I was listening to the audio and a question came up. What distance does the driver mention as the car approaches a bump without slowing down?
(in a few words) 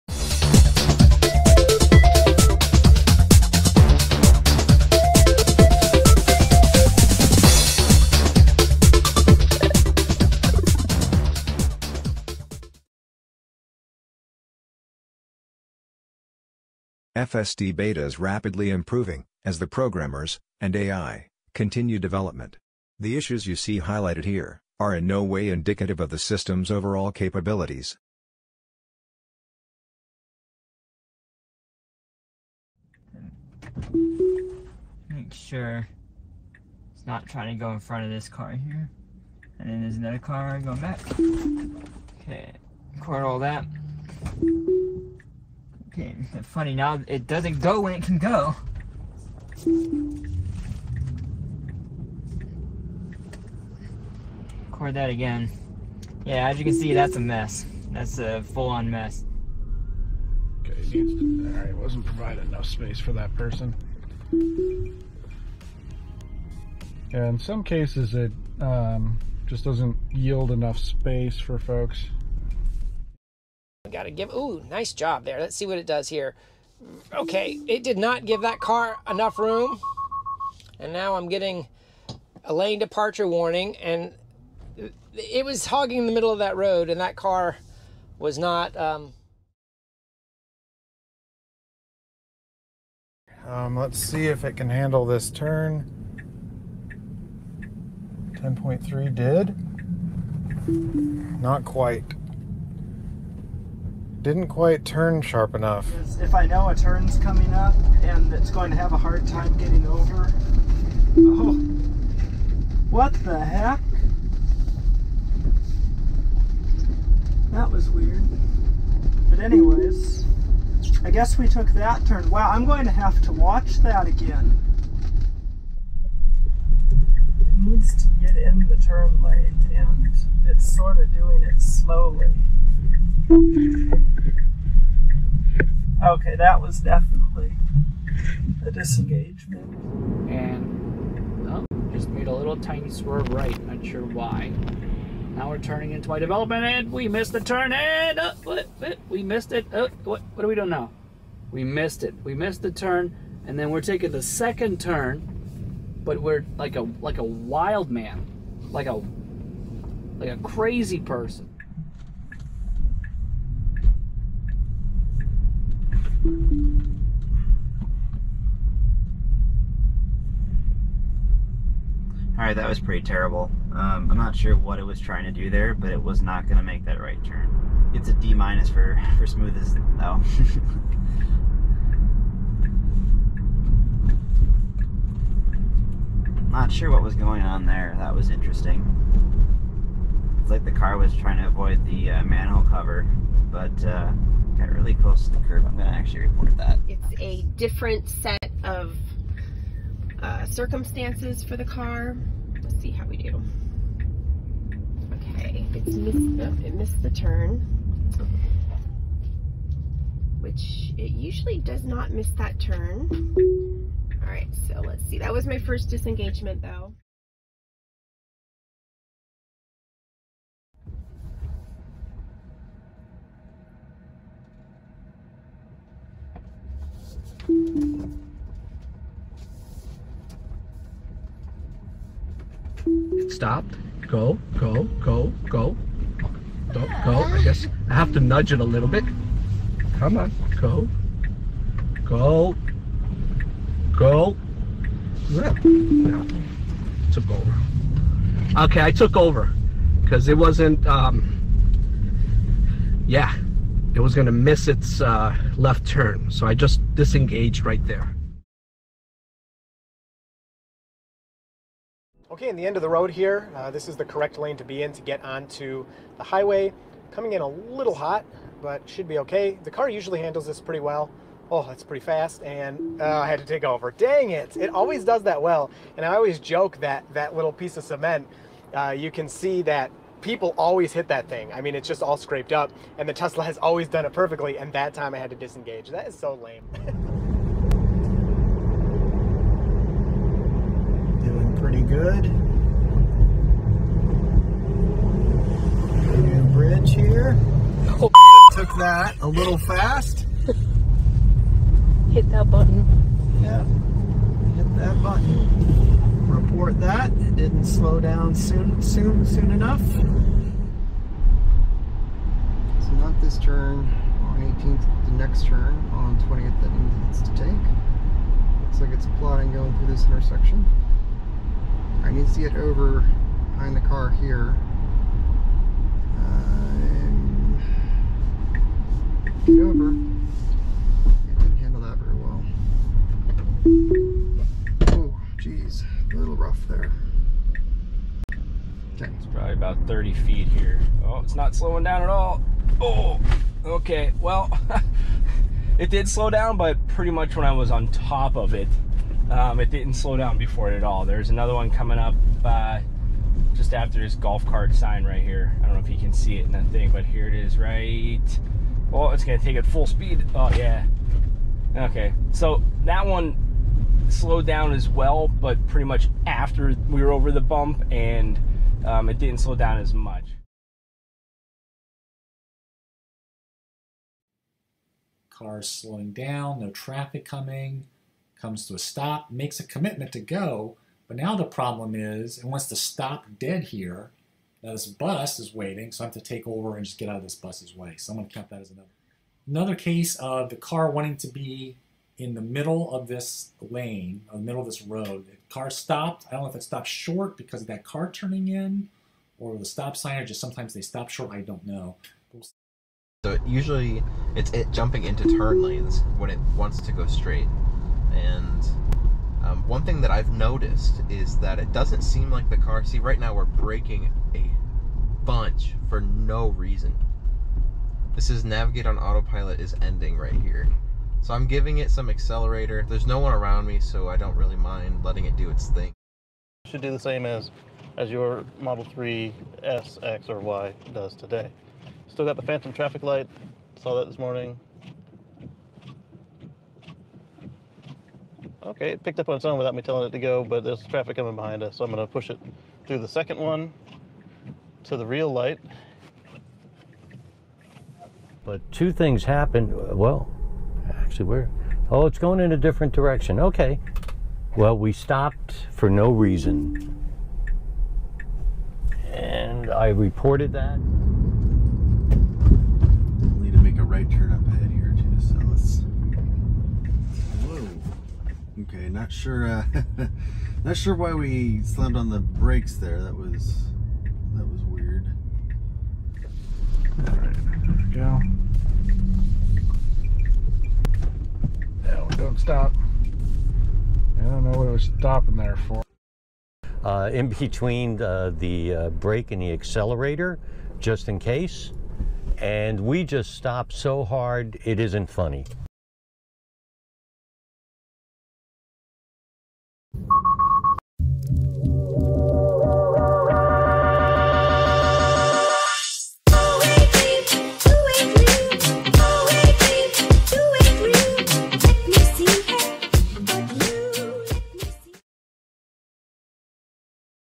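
30 feet.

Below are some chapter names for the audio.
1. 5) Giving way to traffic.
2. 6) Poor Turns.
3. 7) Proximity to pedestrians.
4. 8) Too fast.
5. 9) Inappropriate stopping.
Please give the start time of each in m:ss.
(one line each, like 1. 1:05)
1. 0:28
2. 1:29
3. 3:37
4. 4:18
5. 6:10.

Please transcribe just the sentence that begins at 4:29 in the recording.
The car usually handles this pretty well.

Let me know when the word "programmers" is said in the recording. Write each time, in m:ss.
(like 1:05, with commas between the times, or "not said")
0:19.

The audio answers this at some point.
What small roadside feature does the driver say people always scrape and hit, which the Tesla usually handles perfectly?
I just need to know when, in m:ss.
4:37.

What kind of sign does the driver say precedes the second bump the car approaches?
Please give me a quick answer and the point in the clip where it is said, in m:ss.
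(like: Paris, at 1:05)
Golf cart sign, at 5:54.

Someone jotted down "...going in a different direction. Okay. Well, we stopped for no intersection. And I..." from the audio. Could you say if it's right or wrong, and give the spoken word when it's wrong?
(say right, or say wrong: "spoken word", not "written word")
wrong: "reason", not "intersection".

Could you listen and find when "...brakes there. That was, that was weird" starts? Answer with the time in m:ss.
7:52.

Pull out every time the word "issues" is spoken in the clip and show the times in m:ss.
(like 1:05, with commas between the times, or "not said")
0:23.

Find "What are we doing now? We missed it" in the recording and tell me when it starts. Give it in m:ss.
2:30.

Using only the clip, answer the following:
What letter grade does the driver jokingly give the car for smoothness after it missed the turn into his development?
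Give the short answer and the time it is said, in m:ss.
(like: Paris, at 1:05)
D minus, at 2:58.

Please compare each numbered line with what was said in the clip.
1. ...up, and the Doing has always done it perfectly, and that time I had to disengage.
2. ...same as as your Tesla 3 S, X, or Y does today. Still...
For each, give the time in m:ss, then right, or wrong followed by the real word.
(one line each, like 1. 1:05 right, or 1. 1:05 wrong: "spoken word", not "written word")
1. 4:42 wrong: "Tesla", not "Doing"
2. 7:06 wrong: "Model", not "Tesla".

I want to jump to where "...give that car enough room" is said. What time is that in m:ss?
1:18.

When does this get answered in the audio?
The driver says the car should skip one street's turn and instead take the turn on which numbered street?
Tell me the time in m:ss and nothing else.
5:16.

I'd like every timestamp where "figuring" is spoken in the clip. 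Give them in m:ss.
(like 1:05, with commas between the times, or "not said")
not said.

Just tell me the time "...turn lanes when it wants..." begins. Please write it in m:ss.
6:45.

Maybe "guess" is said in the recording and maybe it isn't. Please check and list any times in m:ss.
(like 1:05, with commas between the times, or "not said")
2:01, 3:57.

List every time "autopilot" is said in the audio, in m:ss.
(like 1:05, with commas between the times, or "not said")
6:58.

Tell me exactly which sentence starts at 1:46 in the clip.
If I know a turn's coming up and it's going to have a hard time getting over.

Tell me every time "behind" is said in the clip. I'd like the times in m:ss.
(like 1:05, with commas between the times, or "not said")
5:23, 7:21.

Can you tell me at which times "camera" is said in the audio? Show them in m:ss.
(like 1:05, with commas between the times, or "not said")
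not said.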